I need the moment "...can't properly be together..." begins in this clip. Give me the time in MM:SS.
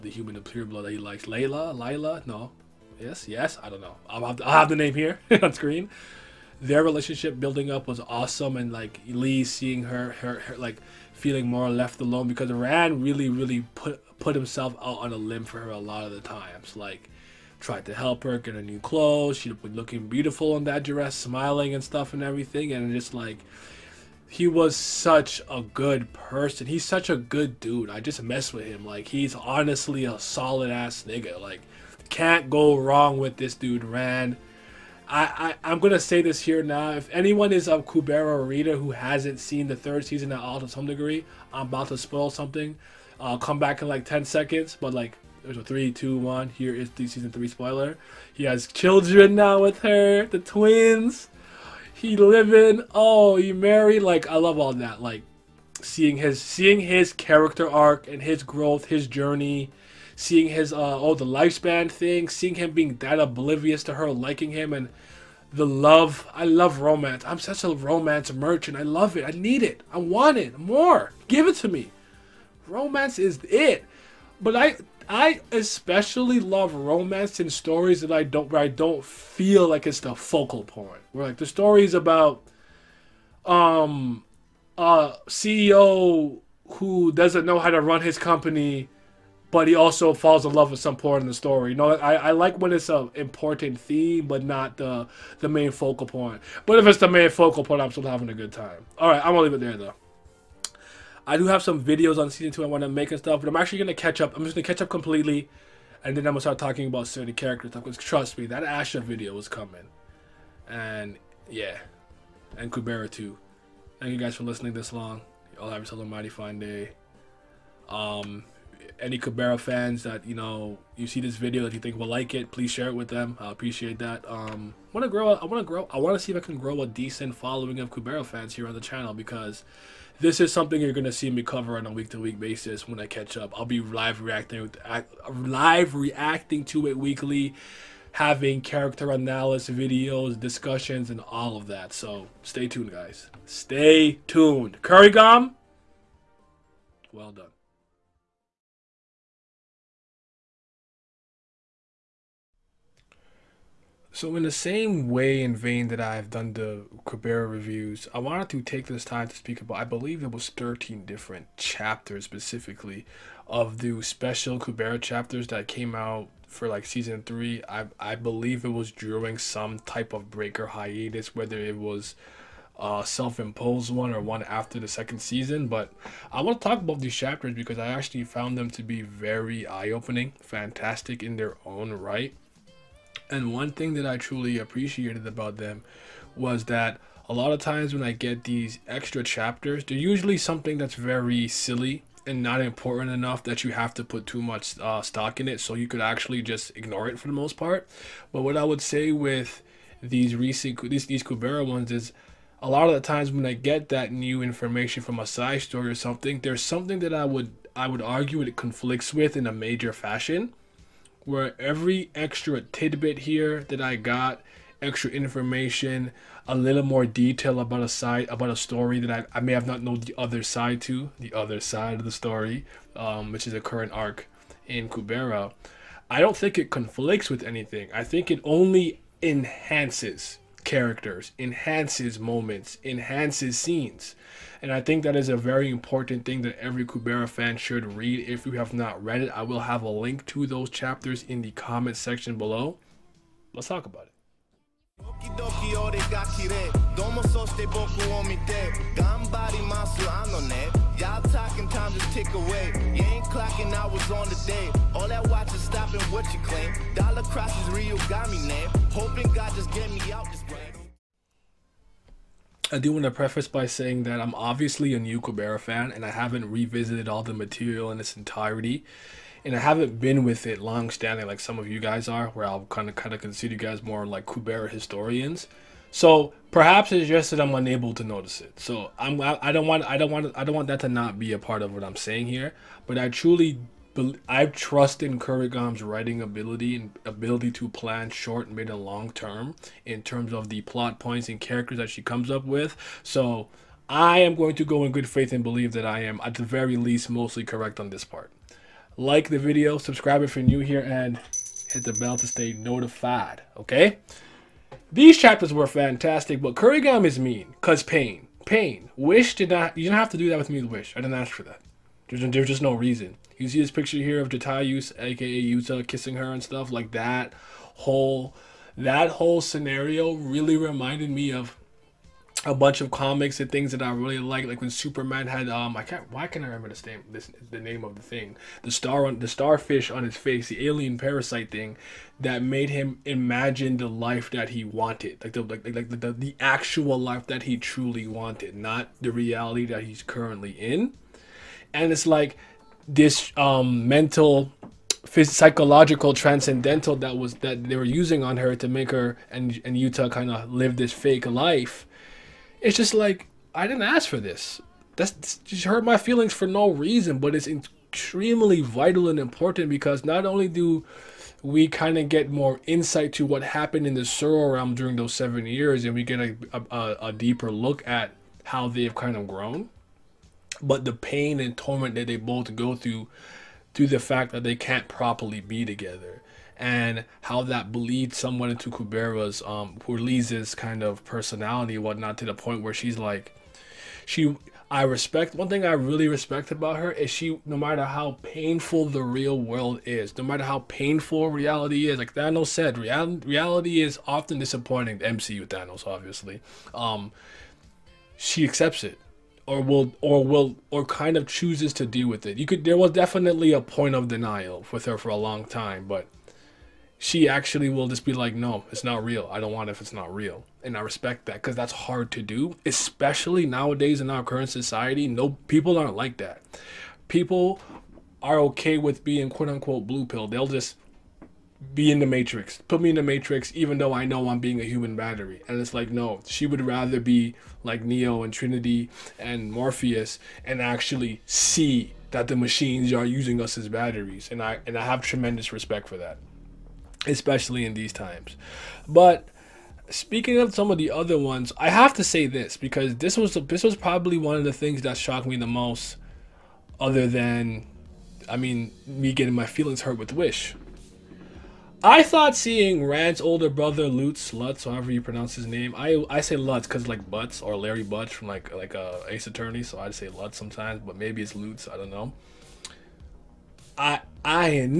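06:14.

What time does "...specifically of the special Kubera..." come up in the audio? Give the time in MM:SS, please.
02:42.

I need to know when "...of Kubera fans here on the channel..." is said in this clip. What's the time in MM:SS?
02:07.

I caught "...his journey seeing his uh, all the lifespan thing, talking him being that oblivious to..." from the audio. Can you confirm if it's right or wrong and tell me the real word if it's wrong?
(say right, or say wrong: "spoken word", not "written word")
wrong: "seeing", not "talking".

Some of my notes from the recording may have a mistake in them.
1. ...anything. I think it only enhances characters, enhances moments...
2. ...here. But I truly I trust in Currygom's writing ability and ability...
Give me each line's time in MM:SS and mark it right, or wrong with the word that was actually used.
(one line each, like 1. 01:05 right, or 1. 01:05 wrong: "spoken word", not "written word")
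1. 03:47 right
2. 04:42 right.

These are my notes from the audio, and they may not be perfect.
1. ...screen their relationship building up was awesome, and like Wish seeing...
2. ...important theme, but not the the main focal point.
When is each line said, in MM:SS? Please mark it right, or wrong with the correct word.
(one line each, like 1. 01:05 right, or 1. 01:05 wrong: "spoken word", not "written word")
1. 00:05 wrong: "Lee", not "Wish"
2. 01:33 right.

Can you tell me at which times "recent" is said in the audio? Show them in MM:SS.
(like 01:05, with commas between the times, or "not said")
03:20.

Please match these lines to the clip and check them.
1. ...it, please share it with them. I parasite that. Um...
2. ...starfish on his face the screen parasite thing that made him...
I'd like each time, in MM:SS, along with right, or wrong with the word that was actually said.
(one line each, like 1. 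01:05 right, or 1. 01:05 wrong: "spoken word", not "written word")
1. 02:02 wrong: "appreciate", not "parasite"
2. 05:29 wrong: "alien", not "screen".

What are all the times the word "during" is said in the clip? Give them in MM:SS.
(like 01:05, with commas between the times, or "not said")
02:48, 06:04.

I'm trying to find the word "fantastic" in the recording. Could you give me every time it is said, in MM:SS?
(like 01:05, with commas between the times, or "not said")
03:00, 05:05.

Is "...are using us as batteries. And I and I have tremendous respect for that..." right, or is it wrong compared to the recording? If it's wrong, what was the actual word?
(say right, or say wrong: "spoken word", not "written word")
right.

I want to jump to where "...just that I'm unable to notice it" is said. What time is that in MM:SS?
04:37.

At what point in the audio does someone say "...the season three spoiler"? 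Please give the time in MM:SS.
00:46.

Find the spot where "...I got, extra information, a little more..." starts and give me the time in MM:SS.
03:33.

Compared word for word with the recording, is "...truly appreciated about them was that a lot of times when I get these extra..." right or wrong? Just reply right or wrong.
right.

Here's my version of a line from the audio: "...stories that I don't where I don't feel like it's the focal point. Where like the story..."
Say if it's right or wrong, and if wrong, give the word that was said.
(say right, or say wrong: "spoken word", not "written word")
right.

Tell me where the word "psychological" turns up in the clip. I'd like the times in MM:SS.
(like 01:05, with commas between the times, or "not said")
05:45.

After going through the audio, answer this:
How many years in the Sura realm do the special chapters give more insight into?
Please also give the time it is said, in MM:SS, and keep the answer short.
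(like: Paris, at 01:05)
seven, at 06:05.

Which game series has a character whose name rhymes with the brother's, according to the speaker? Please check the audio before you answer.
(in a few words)
Ace Attorney.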